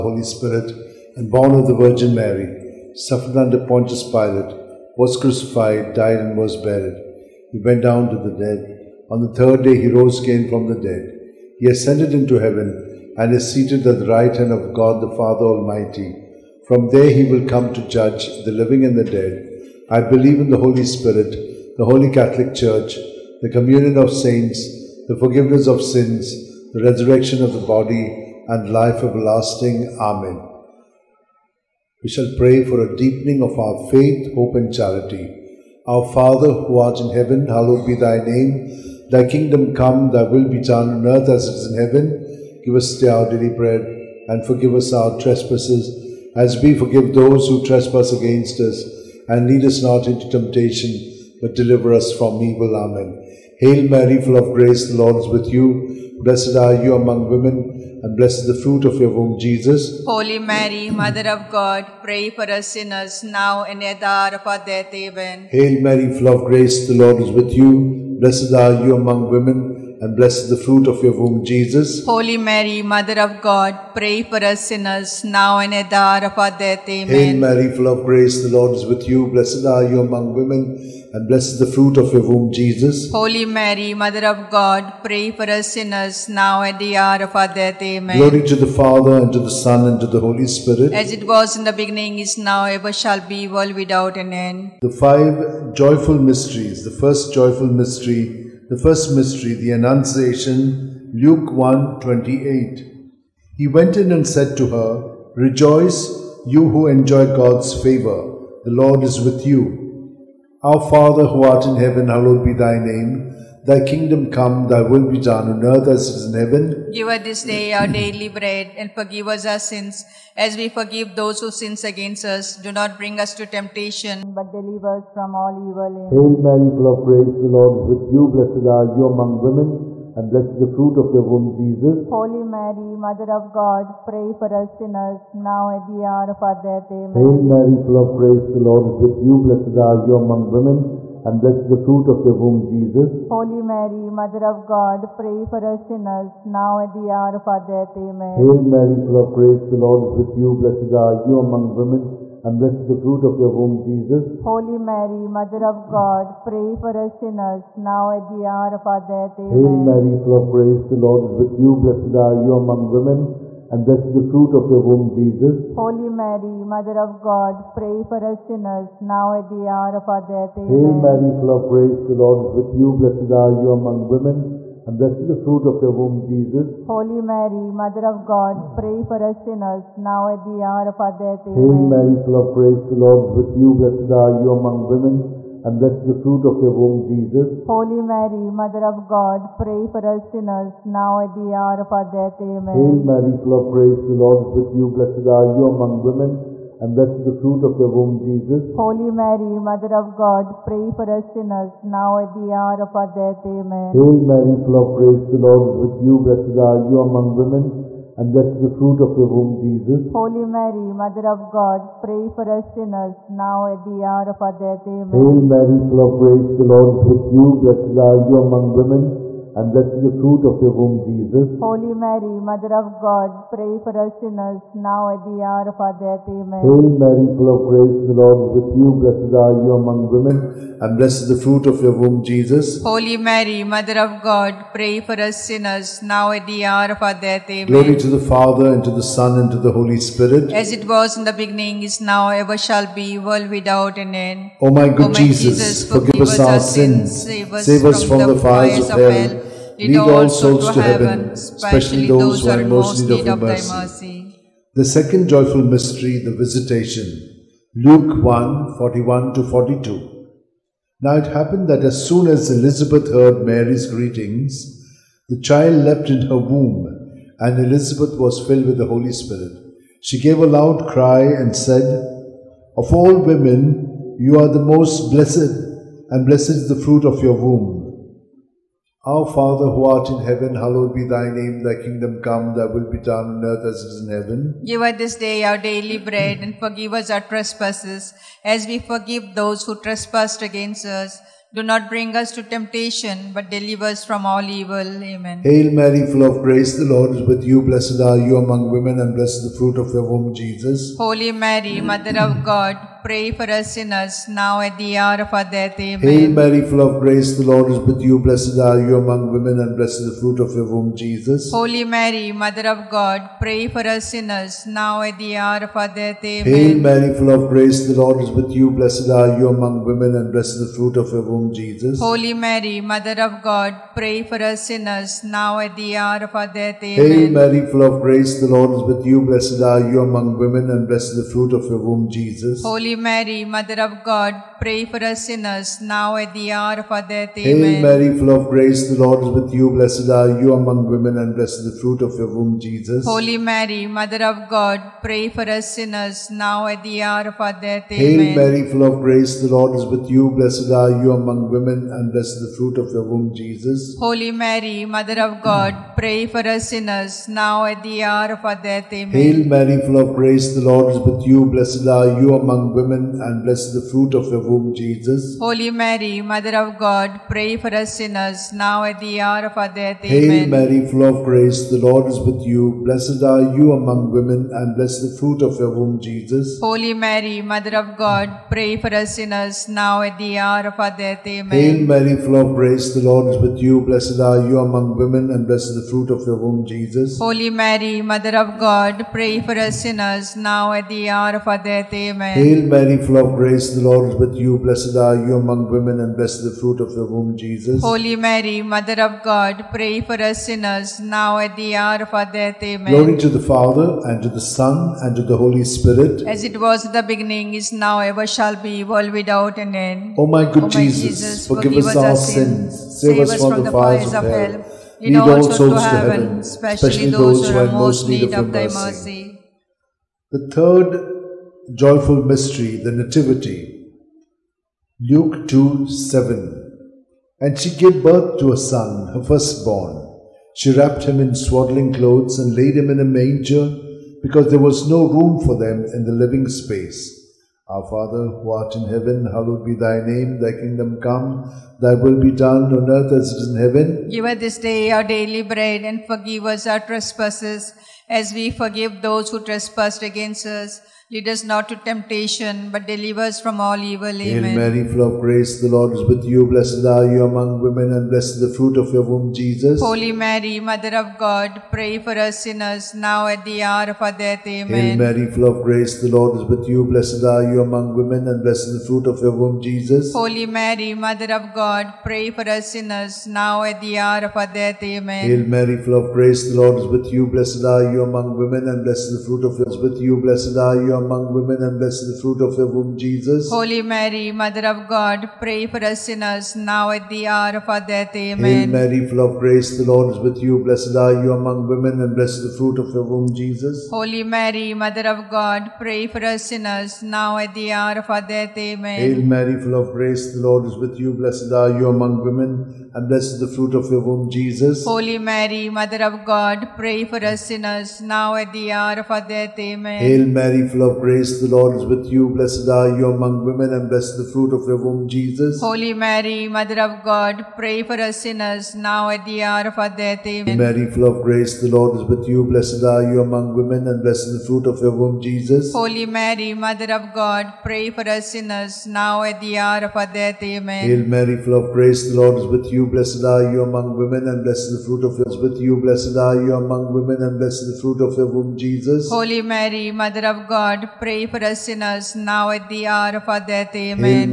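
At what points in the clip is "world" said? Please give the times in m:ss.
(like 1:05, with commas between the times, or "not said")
1:33, 4:03, 6:48.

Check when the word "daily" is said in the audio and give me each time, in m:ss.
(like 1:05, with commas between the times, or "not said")
0:43, 1:57, 4:45, 7:25.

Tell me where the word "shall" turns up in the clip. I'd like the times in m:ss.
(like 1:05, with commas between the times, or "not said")
0:32, 1:32, 4:02, 6:48.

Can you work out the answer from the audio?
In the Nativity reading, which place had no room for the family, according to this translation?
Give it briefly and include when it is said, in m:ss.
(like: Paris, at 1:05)
The living space, at 7:16.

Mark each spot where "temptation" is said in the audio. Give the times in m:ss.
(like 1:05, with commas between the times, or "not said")
0:50, 2:03, 4:52, 7:31.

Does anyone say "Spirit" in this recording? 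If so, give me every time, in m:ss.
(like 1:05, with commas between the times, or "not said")
0:00, 0:20, 1:30, 3:59, 4:29, 6:45.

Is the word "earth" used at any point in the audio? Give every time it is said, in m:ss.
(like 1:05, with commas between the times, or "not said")
0:41, 1:55, 4:43, 7:22.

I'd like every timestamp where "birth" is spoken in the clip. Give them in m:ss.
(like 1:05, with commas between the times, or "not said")
7:08.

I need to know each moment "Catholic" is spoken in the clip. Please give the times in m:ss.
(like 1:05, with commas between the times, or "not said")
0:22.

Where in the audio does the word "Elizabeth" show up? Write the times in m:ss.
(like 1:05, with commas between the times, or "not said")
4:22, 4:27.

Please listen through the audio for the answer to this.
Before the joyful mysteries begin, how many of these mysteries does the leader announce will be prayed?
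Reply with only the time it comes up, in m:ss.
1:34.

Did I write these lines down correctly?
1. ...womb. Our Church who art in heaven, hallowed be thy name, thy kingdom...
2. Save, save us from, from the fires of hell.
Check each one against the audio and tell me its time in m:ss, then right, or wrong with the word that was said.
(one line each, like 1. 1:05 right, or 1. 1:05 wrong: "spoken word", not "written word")
1. 4:37 wrong: "Father", not "Church"
2. 6:53 right.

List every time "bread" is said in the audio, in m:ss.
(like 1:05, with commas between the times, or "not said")
0:43, 1:58, 4:45, 7:25.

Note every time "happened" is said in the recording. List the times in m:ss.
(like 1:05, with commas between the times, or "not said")
4:21.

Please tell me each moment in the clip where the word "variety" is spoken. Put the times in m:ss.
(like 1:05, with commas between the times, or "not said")
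not said.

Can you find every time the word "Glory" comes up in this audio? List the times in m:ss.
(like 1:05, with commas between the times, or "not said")
1:28, 3:57, 6:42.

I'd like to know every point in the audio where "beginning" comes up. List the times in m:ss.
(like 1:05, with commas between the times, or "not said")
1:31, 4:01, 6:47.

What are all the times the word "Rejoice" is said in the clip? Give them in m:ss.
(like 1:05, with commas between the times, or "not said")
1:45.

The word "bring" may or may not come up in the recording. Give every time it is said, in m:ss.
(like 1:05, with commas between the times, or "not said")
2:02, 4:51.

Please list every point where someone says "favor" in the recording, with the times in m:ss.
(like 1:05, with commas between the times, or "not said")
1:47.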